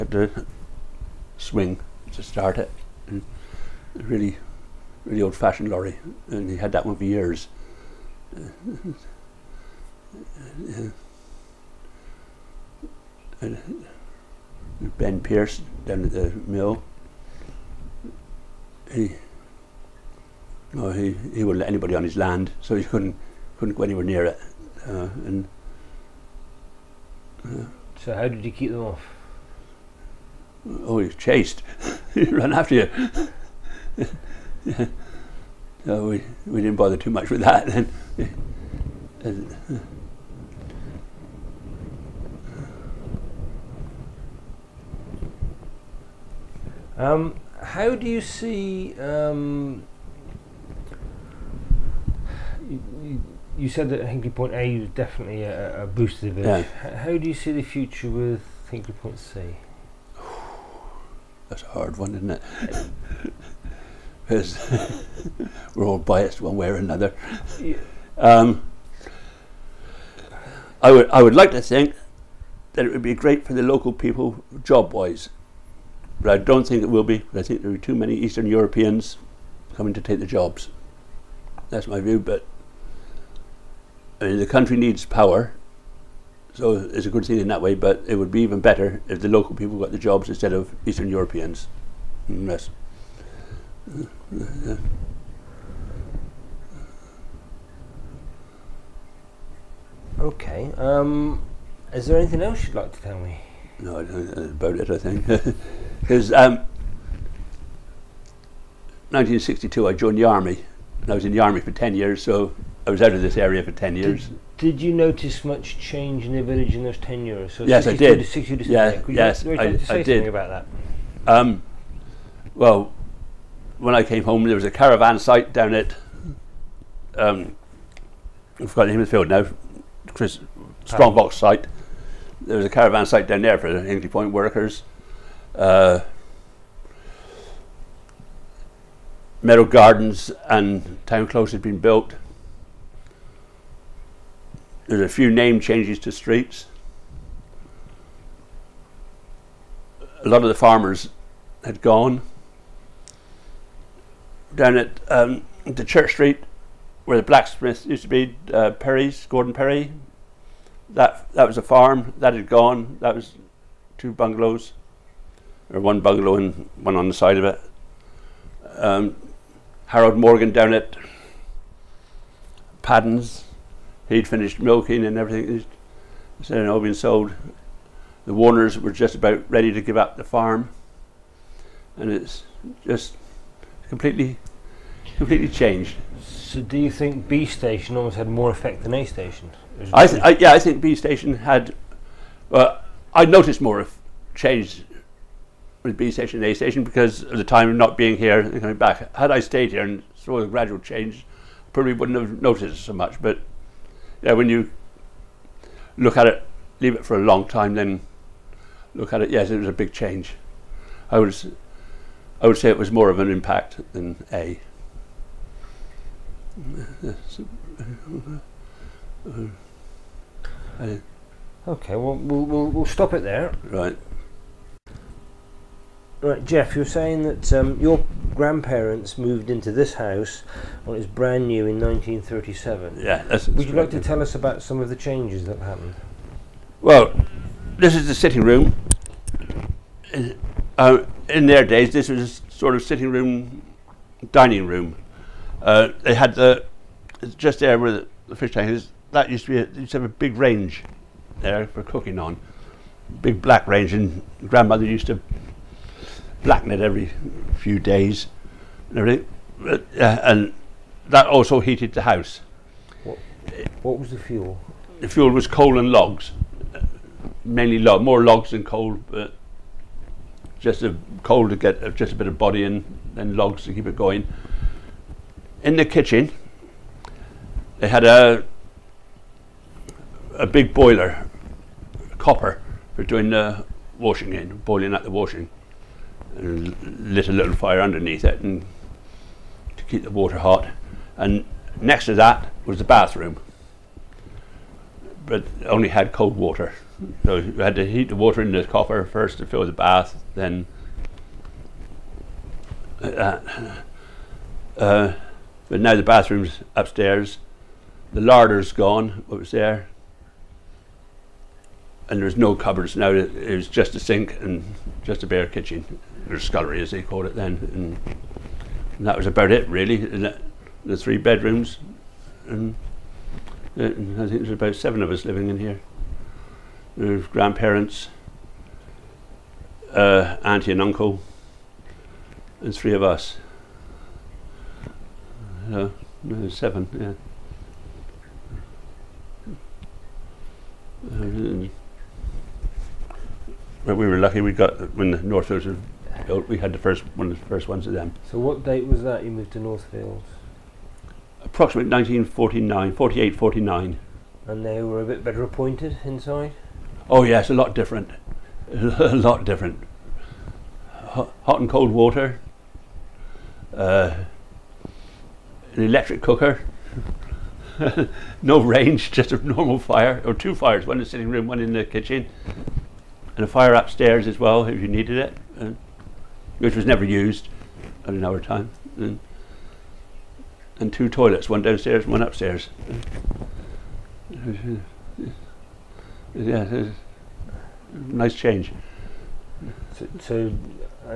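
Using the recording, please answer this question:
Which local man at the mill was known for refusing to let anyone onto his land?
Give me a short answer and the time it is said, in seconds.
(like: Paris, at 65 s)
Ben Pierce, at 14 s.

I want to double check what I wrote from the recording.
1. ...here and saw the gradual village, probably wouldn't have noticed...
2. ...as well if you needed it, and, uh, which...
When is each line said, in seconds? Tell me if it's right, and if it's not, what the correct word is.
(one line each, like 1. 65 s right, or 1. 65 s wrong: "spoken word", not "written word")
1. 199 s wrong: "change", not "village"
2. 374 s right.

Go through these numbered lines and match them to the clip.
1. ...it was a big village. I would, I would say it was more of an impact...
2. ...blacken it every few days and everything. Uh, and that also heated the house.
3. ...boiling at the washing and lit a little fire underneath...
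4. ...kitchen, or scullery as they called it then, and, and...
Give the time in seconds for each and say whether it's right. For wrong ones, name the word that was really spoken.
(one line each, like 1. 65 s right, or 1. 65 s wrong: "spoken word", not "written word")
1. 209 s wrong: "change", not "village"
2. 256 s right
3. 284 s right
4. 315 s right.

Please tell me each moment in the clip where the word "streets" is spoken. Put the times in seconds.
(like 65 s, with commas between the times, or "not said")
146 s, 156 s.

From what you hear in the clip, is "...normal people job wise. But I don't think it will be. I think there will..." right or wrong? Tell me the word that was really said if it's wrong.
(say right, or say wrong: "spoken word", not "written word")
wrong: "local", not "normal".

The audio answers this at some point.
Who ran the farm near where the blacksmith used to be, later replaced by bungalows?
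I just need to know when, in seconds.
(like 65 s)
159 s.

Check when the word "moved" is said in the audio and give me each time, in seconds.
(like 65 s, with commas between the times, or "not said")
229 s, 349 s.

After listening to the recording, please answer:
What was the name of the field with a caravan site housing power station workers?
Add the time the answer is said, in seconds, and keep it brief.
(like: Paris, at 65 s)
Strongbox site, at 130 s.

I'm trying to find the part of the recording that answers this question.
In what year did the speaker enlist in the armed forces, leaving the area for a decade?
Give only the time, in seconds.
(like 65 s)
109 s.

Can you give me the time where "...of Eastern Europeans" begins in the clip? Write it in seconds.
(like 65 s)
90 s.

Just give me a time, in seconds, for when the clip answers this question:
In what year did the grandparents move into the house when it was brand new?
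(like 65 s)
231 s.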